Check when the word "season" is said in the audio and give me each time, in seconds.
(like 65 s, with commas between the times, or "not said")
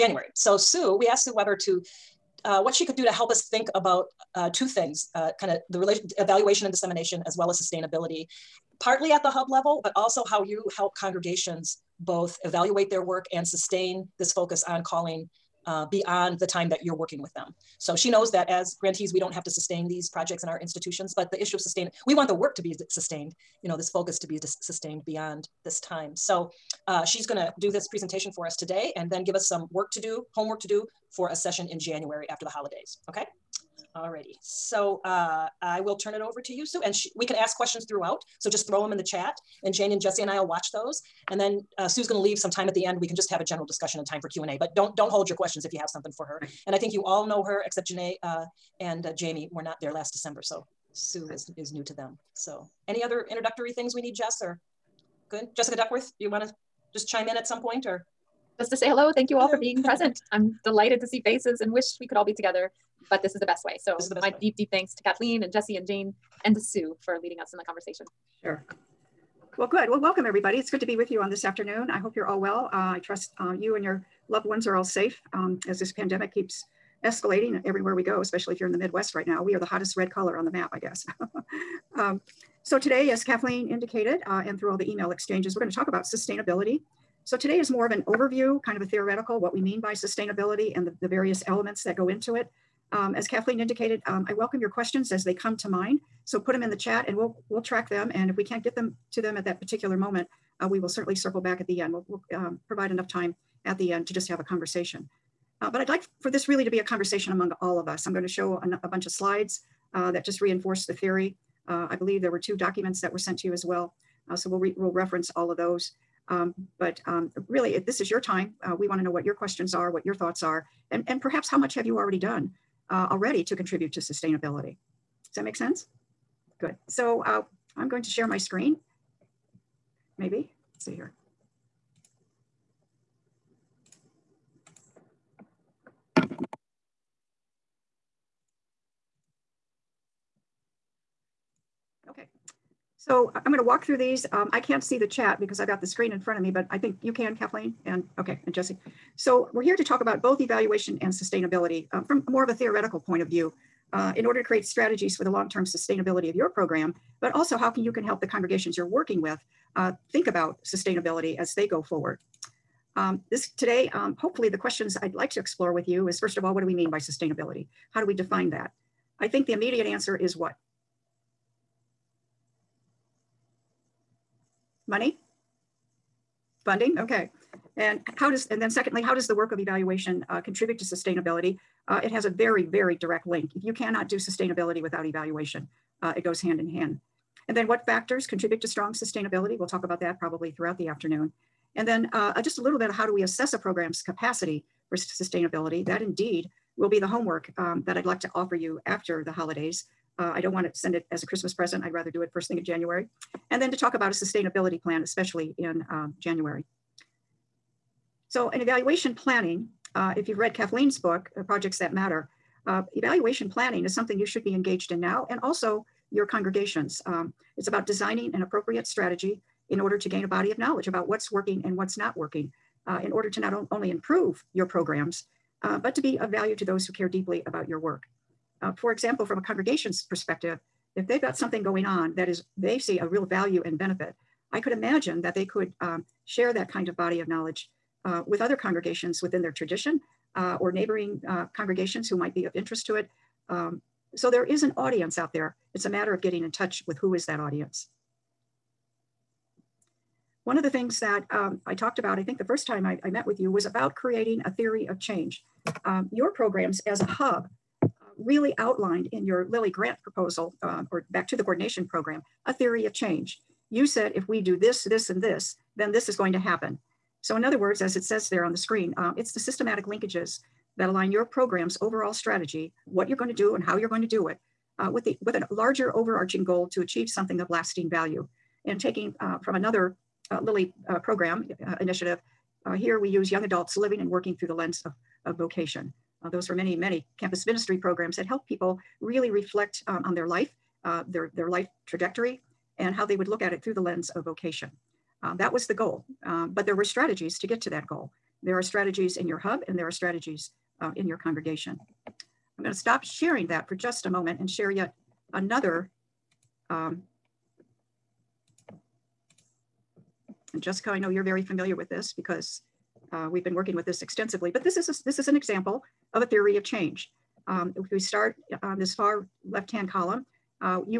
not said.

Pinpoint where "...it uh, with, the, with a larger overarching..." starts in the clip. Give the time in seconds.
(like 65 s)
274 s.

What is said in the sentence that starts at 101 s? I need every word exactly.
We'll, we'll um, provide enough time at the end to just have a conversation.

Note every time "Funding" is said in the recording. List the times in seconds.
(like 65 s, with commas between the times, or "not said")
176 s.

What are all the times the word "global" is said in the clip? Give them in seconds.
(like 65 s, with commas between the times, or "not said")
not said.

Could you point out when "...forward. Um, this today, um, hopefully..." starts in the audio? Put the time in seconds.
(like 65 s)
161 s.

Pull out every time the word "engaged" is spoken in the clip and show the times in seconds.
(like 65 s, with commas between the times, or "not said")
214 s.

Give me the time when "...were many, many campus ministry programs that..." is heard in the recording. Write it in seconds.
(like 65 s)
286 s.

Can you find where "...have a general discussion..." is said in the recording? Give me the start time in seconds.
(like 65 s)
43 s.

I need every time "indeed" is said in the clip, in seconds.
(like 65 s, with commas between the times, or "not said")
195 s.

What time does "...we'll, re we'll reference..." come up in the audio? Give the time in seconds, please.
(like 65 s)
114 s.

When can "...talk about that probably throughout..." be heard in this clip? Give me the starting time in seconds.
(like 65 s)
189 s.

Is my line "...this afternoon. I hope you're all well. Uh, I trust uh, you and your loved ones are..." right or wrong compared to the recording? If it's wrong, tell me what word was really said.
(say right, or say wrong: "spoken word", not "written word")
right.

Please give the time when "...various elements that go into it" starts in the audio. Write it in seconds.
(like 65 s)
91 s.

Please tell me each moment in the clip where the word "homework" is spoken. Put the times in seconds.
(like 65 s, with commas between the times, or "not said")
30 s, 197 s.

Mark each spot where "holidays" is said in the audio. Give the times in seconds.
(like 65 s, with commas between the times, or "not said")
32 s, 199 s.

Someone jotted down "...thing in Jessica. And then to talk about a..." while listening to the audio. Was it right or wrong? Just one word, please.
wrong.